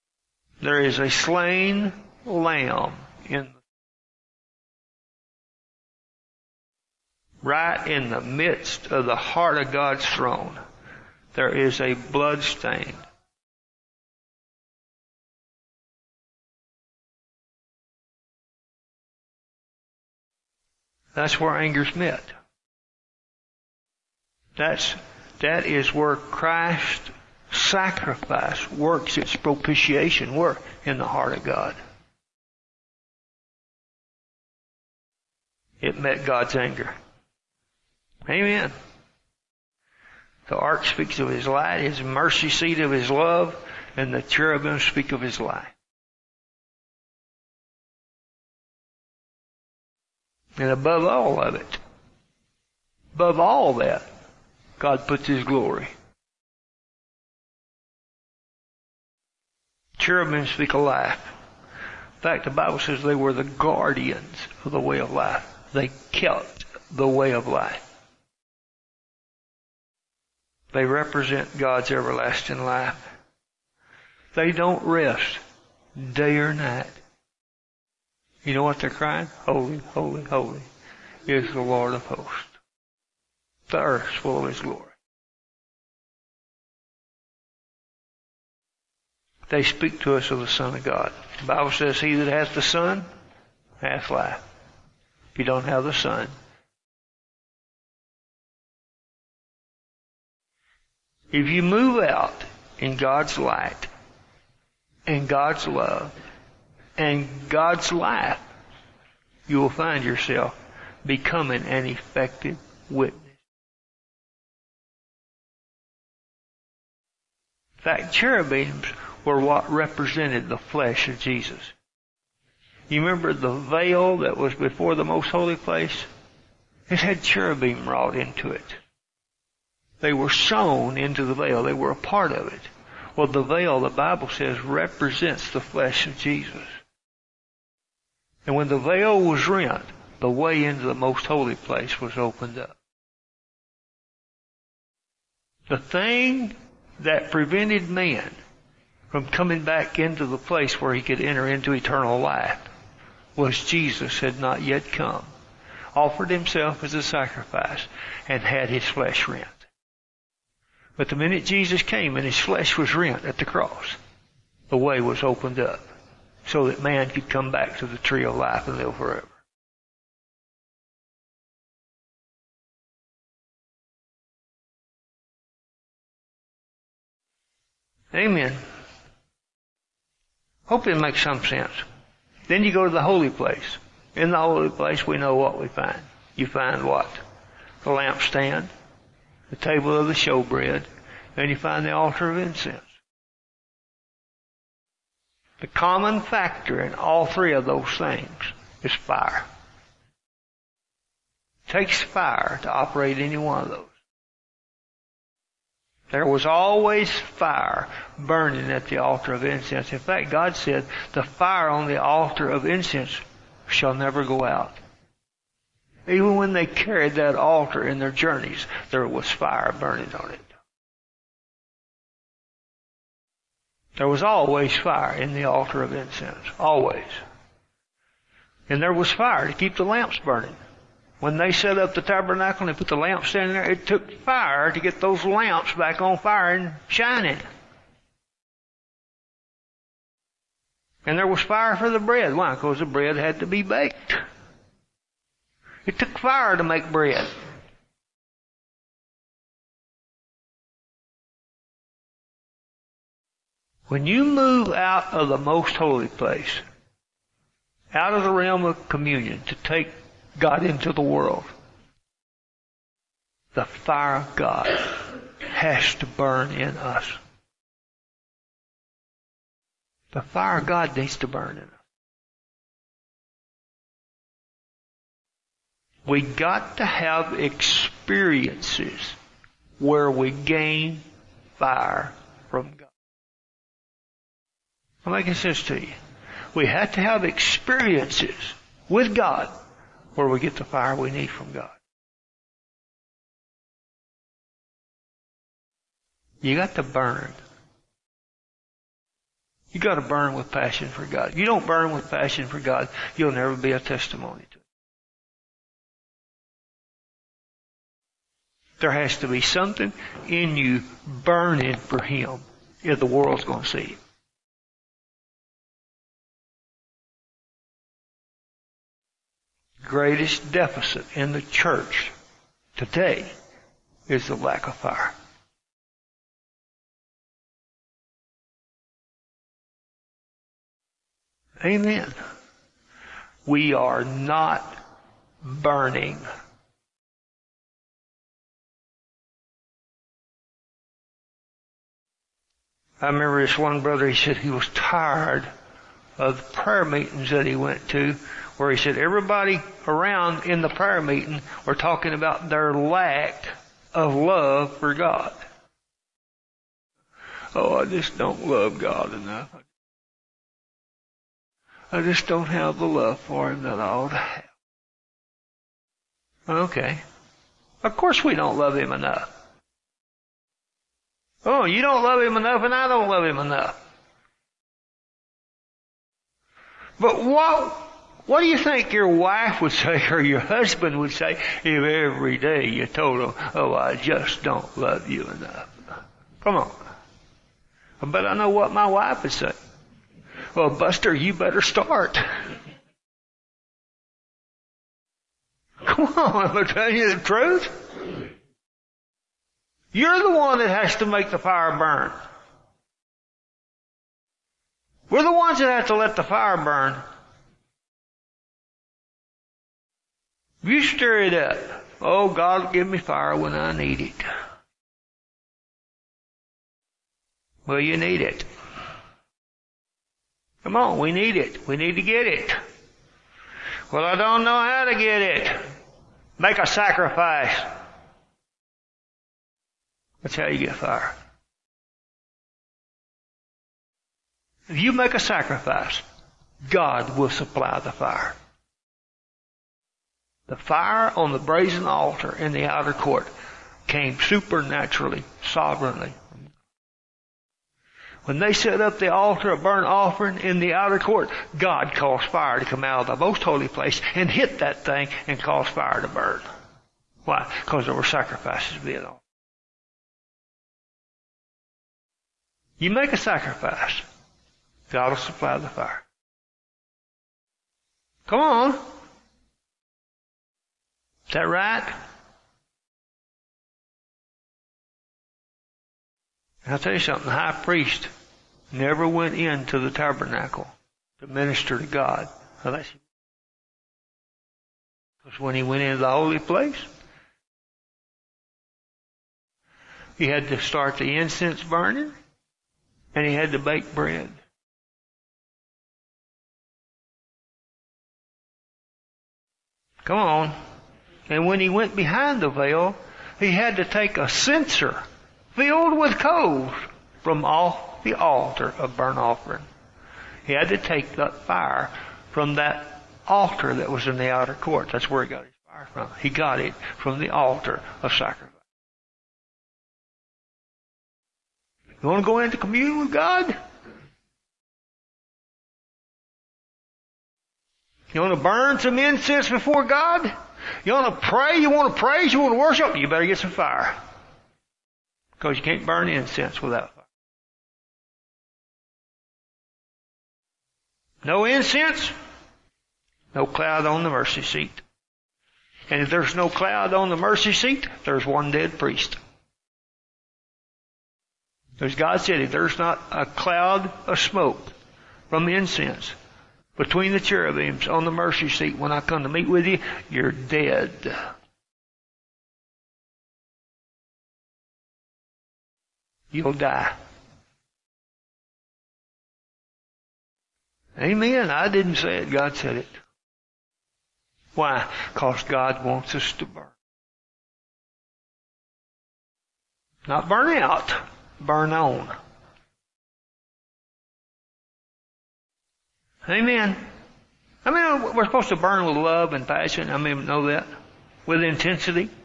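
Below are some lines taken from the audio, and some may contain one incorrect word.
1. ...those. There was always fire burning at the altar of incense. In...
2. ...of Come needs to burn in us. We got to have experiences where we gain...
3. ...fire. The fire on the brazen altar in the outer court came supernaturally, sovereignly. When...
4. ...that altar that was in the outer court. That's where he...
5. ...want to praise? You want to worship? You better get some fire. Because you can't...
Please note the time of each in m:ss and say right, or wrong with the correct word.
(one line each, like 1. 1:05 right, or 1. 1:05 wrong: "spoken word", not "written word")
1. 3:23 right
2. 4:30 wrong: "God", not "Come"
3. 7:17 right
4. 8:32 right
5. 8:51 right.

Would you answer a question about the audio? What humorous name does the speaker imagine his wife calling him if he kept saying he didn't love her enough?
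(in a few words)
Buster.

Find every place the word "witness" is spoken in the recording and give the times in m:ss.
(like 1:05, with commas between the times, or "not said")
1:52.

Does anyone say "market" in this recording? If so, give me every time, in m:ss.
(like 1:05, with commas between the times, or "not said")
not said.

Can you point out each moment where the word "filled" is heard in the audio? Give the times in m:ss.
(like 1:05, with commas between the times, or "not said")
8:25.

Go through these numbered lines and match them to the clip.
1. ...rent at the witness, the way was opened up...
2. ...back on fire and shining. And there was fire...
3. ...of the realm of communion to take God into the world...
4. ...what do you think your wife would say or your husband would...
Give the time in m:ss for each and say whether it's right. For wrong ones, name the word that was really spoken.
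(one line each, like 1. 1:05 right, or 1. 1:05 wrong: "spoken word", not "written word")
1. 2:42 wrong: "cross", not "witness"
2. 3:55 right
3. 4:18 right
4. 6:18 right.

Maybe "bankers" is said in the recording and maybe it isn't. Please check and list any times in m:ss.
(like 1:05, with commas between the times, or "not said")
not said.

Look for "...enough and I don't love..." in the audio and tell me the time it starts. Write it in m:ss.
6:12.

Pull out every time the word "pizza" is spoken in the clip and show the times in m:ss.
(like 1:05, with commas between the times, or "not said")
not said.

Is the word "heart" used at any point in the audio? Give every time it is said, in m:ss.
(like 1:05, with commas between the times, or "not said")
0:09, 0:31.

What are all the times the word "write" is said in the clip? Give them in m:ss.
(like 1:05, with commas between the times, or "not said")
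not said.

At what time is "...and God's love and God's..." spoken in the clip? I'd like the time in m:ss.
1:45.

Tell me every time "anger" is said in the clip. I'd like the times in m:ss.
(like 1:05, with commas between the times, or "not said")
0:21, 0:36.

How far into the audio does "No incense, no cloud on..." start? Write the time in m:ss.
9:01.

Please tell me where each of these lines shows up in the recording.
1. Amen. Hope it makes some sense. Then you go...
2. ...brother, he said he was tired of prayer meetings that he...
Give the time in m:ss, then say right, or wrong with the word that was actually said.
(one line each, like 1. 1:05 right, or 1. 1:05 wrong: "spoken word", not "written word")
1. 2:58 right
2. 5:43 right.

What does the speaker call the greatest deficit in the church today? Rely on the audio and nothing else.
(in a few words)
Lack of fire.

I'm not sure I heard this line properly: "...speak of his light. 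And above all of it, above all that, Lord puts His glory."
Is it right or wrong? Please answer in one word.
wrong.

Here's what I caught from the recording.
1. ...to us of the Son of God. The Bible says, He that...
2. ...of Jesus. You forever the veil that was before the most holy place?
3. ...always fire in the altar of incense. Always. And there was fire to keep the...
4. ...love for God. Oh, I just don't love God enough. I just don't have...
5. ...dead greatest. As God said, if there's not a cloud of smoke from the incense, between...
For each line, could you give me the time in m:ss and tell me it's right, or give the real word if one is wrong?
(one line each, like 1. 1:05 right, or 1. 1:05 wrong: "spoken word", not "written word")
1. 1:30 right
2. 2:01 wrong: "remember", not "forever"
3. 3:44 right
4. 5:54 right
5. 9:08 wrong: "priest", not "greatest".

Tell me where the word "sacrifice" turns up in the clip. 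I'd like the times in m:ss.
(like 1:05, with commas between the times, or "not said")
0:27, 2:37, 7:06, 7:15, 7:38, 7:43, 8:38.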